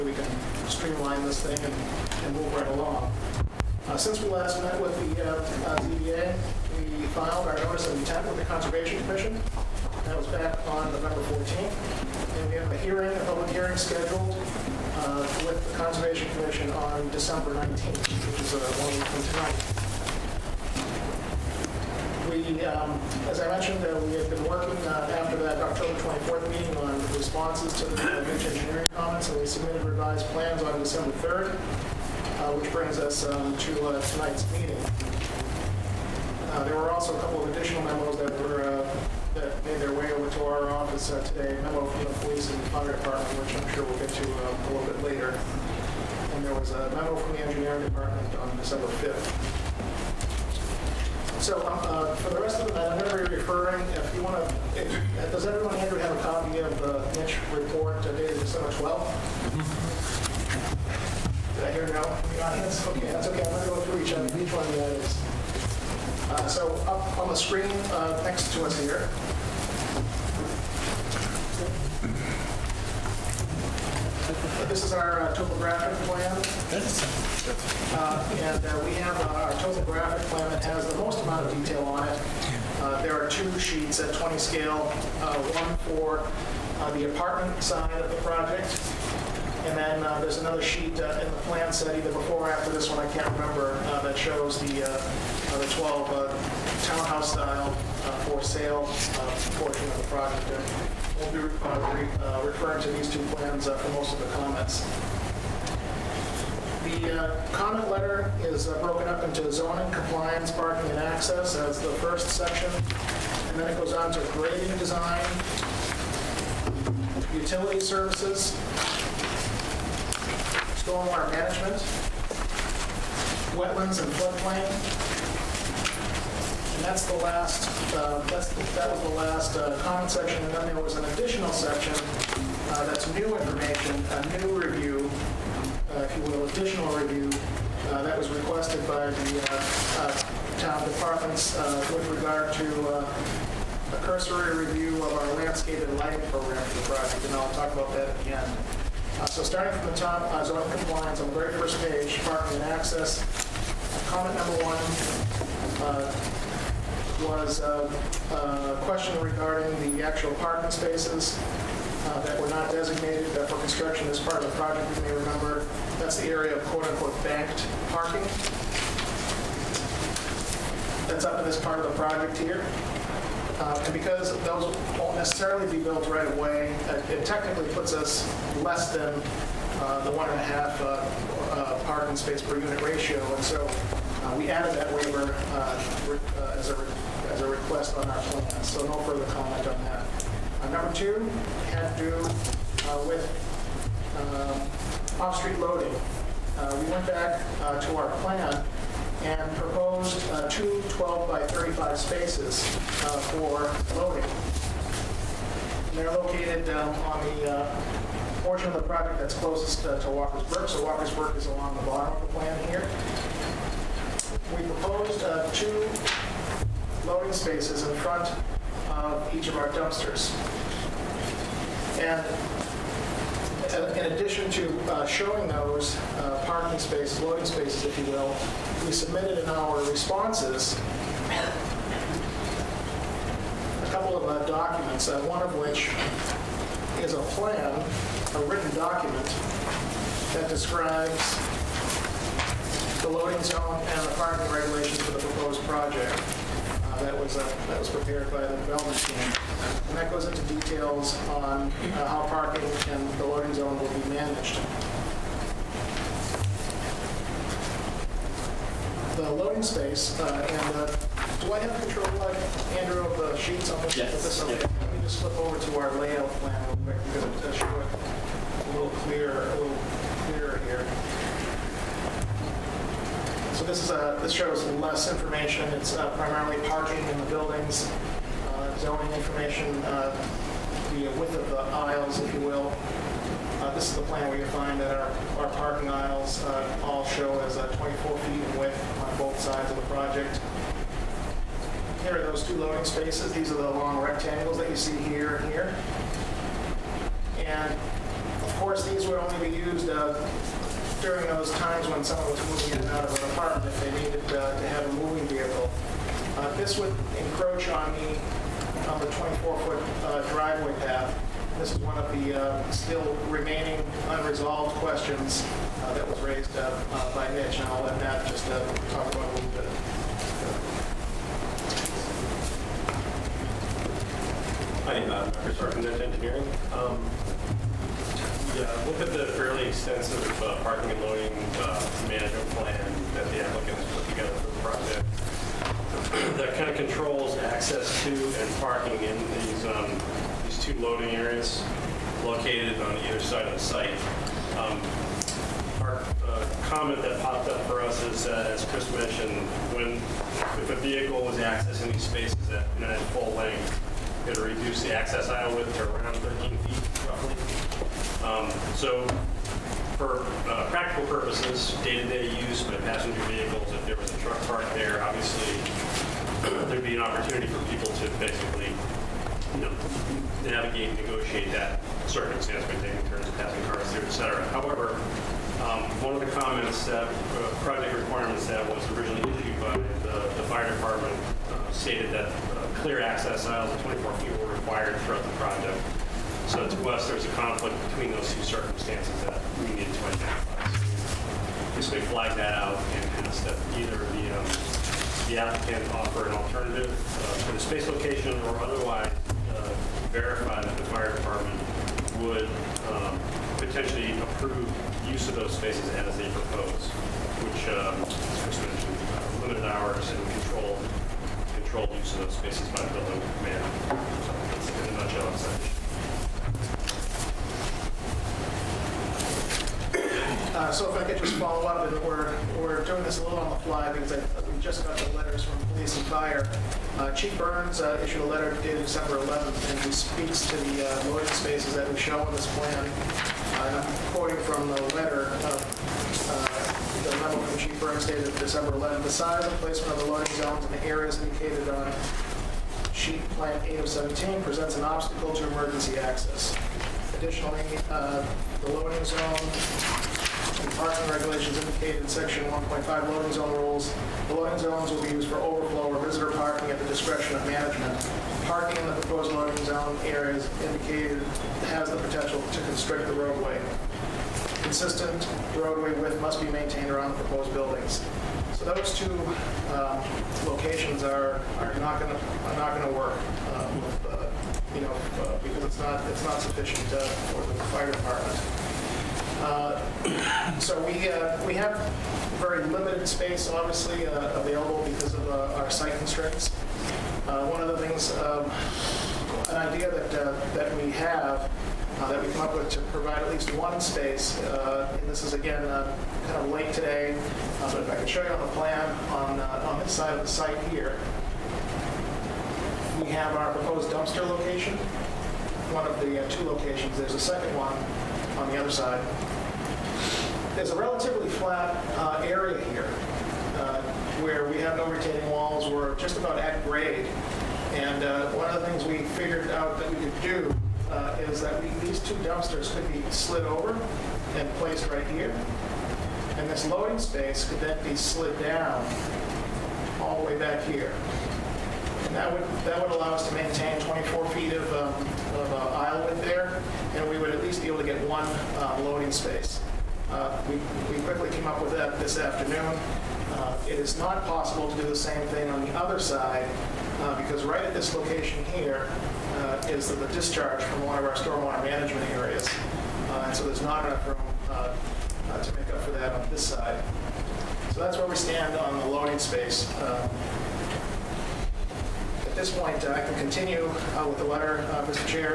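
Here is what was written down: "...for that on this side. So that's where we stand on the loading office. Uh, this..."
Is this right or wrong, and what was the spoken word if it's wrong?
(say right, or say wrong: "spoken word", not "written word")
wrong: "space", not "office".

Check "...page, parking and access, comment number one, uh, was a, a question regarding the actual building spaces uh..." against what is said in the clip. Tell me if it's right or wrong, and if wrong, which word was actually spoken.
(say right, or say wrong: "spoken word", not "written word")
wrong: "parking", not "building".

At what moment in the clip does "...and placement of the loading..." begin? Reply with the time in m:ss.
7:19.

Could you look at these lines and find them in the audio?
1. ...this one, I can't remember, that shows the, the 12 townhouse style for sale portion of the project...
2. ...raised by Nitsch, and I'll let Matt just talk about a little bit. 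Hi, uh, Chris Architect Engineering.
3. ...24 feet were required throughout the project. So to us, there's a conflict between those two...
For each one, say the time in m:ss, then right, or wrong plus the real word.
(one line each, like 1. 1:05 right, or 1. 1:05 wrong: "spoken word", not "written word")
1. 1:32 right
2. 5:16 right
3. 6:23 right.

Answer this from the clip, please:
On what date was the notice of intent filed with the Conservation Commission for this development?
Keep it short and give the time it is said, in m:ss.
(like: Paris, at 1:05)
November 14th, at 0:10.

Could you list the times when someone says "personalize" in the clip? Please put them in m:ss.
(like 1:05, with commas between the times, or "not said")
not said.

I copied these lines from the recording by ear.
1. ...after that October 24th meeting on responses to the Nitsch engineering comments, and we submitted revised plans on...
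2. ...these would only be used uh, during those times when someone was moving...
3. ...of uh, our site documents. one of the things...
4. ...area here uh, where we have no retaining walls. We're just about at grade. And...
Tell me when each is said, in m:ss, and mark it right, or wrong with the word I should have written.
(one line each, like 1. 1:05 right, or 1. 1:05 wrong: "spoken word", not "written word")
1. 0:25 right
2. 4:58 right
3. 8:05 wrong: "constraints", not "documents"
4. 8:32 right.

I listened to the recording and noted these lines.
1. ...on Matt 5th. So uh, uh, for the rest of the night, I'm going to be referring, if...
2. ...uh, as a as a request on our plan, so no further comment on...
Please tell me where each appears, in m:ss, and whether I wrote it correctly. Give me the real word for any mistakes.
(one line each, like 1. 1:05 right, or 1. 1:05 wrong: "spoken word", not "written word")
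1. 0:48 wrong: "December", not "Matt"
2. 3:05 right.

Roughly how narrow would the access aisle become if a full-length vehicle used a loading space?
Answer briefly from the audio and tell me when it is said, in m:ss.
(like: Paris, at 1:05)
13 feet, at 5:56.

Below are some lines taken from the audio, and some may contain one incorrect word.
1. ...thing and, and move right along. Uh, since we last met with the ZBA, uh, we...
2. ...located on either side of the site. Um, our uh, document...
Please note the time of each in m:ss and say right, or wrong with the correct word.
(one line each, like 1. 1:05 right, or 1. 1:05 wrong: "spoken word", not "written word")
1. 0:01 right
2. 5:42 wrong: "comment", not "document".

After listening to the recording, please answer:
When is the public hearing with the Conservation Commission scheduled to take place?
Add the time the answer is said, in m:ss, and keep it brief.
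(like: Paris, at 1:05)
December 19th, at 0:17.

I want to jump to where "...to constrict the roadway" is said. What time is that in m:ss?
7:42.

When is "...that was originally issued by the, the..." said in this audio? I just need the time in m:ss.
6:18.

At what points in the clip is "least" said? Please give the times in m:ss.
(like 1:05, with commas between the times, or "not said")
8:13, 8:57.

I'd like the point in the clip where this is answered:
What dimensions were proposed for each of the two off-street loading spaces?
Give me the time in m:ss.
3:20.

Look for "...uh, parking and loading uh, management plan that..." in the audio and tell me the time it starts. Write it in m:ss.
5:30.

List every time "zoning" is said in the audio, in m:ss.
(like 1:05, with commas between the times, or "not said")
1:49, 4:38.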